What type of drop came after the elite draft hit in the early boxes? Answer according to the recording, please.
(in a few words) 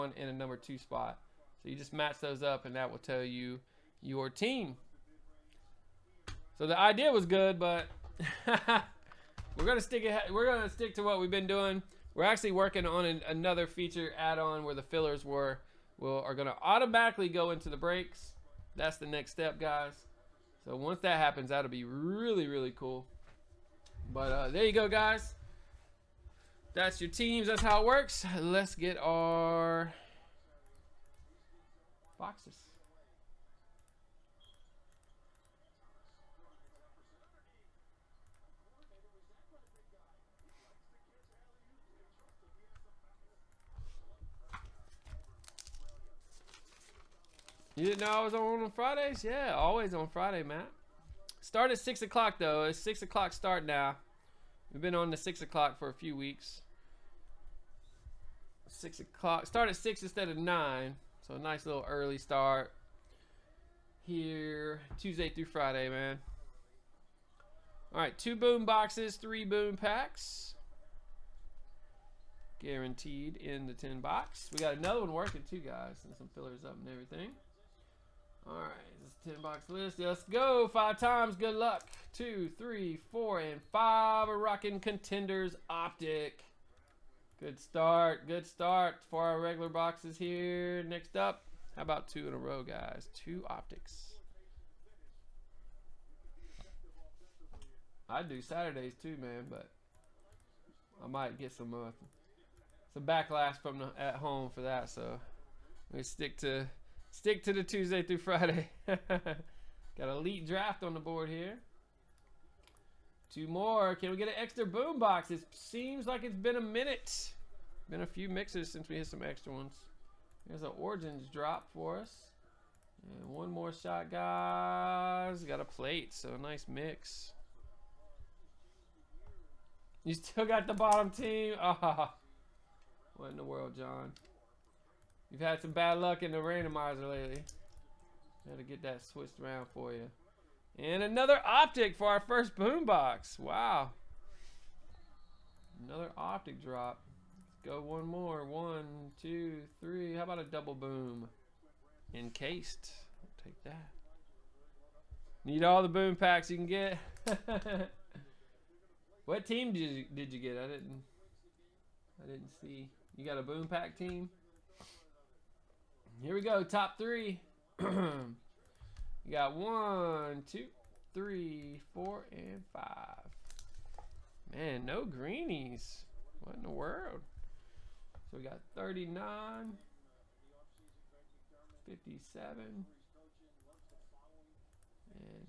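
Origins.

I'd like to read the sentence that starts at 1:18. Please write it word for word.
Alright, this is 10 box list.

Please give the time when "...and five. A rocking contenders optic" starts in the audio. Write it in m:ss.
1:23.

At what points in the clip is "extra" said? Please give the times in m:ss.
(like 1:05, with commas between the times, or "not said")
1:54, 1:59.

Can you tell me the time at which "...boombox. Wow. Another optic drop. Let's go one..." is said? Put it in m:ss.
2:22.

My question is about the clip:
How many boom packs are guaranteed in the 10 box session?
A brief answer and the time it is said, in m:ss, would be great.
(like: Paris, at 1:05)
3, at 1:09.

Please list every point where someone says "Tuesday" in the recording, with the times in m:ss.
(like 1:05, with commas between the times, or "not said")
1:04, 1:47.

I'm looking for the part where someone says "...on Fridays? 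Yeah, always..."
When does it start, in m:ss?
0:48.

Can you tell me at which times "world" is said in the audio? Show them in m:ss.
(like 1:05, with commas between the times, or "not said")
2:13, 2:56.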